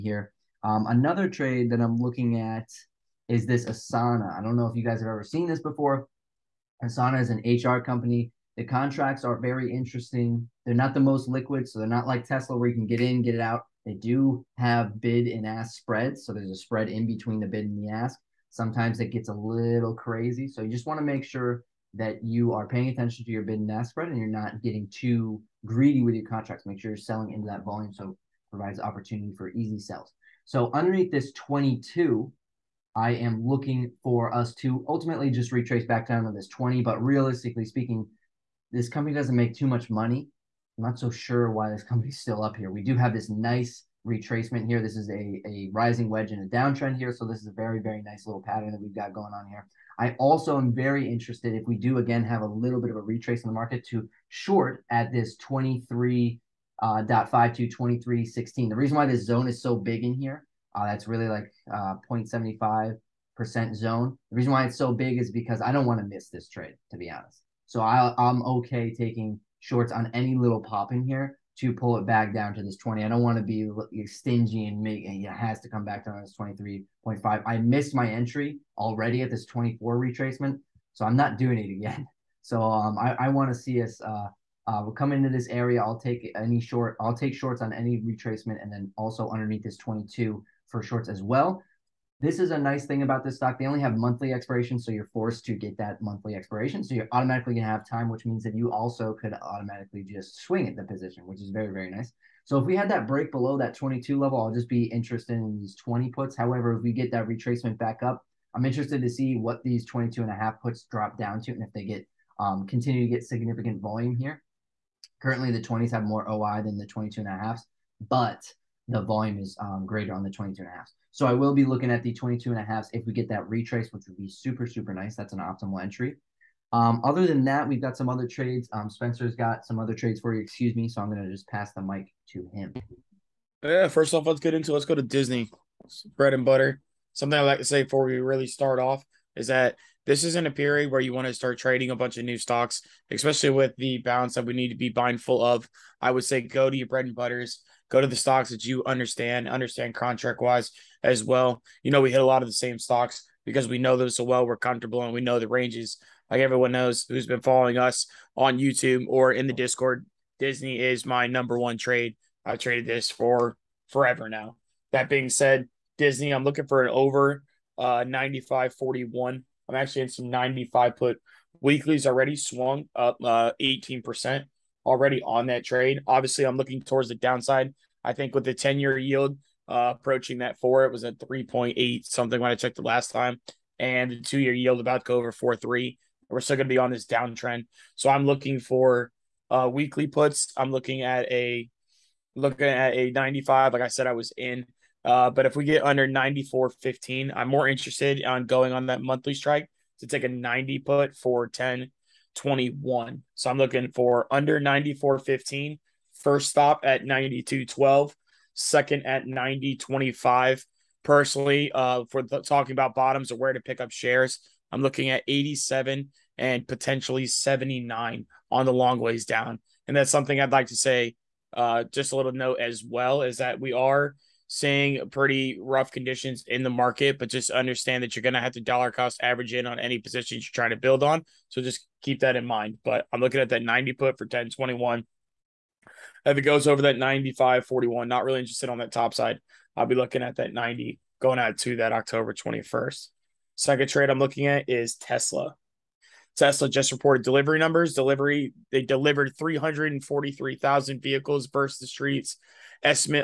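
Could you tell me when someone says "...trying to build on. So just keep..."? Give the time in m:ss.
3:50.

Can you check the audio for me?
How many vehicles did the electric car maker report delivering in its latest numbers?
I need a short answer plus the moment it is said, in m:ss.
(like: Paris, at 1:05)
343,000, at 4:09.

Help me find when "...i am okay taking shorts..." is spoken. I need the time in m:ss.
1:07.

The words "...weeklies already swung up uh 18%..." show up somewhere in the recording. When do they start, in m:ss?
2:51.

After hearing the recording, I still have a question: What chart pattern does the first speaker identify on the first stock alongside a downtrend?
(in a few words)
Rising wedge.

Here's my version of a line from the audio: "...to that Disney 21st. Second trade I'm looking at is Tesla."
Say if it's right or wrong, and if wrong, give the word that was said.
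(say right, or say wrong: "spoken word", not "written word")
wrong: "October", not "Disney".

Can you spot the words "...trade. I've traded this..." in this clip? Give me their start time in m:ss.
2:41.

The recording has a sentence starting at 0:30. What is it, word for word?
So underneath this 22, I am looking for us to ultimately just retrace back down to this 20.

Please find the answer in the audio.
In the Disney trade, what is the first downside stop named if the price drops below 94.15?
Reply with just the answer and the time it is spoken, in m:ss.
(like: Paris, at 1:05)
92.12, at 3:27.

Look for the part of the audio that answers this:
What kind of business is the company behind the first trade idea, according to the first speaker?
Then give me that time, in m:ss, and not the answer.
0:07.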